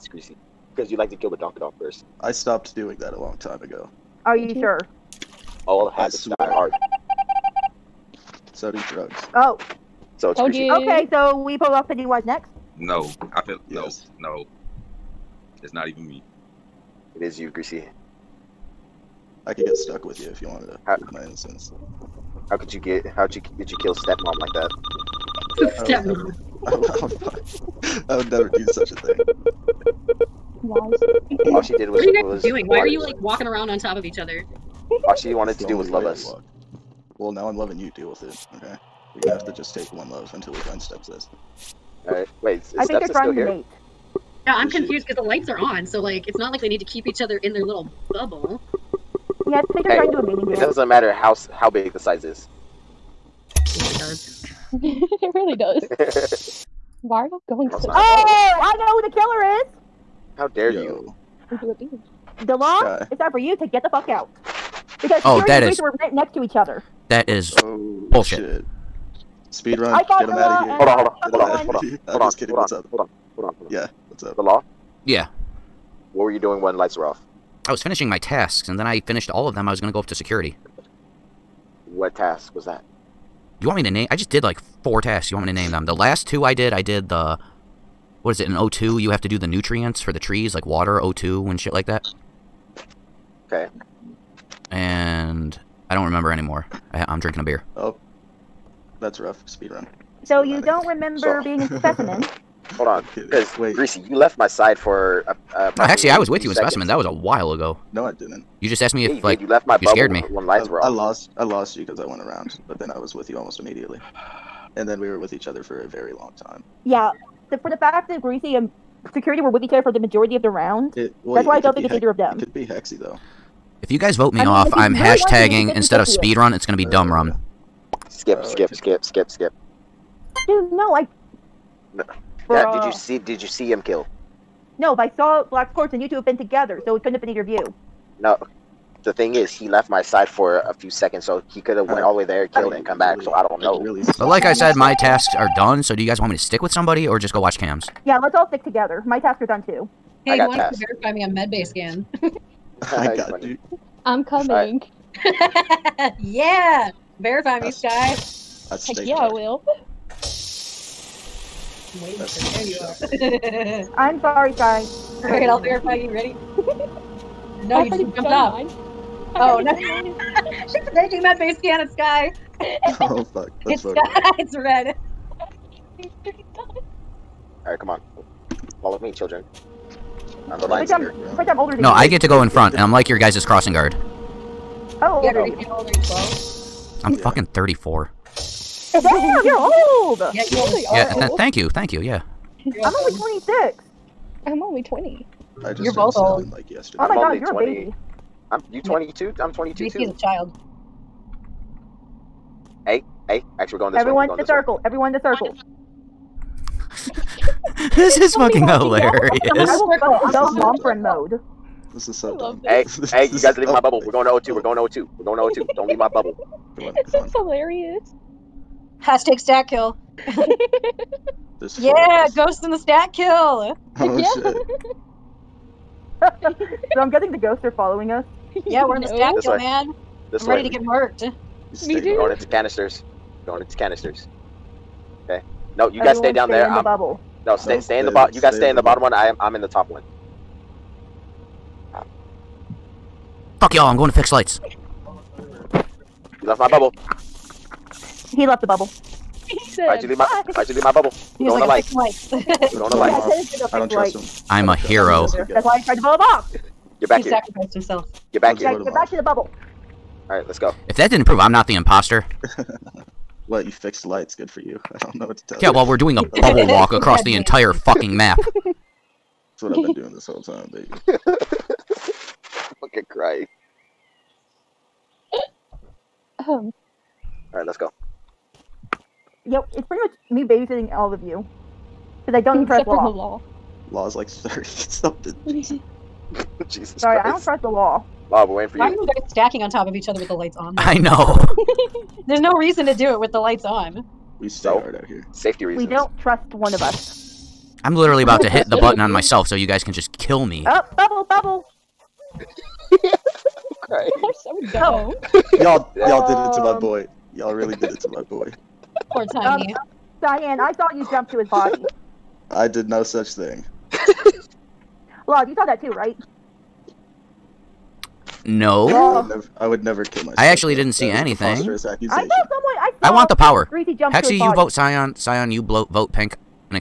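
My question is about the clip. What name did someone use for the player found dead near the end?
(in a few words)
Tiny.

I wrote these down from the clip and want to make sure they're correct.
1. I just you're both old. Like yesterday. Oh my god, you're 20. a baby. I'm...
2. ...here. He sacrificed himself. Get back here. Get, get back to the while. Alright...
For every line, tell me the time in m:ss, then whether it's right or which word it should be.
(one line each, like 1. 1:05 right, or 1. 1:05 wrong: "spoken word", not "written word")
1. 3:15 right
2. 4:17 wrong: "bubble", not "while".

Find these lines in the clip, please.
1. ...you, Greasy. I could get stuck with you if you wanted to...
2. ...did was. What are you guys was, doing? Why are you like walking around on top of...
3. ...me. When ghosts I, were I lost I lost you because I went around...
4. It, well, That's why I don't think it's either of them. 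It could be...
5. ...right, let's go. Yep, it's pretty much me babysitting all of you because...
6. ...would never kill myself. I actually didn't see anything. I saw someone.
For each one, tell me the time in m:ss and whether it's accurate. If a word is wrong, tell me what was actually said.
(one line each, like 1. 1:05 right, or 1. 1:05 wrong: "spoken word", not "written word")
1. 0:17 right
2. 0:31 right
3. 1:50 wrong: "lights", not "ghosts"
4. 2:00 right
5. 4:37 right
6. 5:19 right.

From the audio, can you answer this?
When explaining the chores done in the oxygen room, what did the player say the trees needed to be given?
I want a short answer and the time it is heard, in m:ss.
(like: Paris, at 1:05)
nutrients, at 1:29.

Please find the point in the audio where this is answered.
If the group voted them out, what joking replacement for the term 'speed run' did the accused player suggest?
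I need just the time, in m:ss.
2:06.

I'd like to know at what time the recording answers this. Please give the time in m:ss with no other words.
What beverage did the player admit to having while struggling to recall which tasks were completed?
1:37.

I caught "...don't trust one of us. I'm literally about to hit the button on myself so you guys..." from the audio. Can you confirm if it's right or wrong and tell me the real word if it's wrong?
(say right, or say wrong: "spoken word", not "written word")
right.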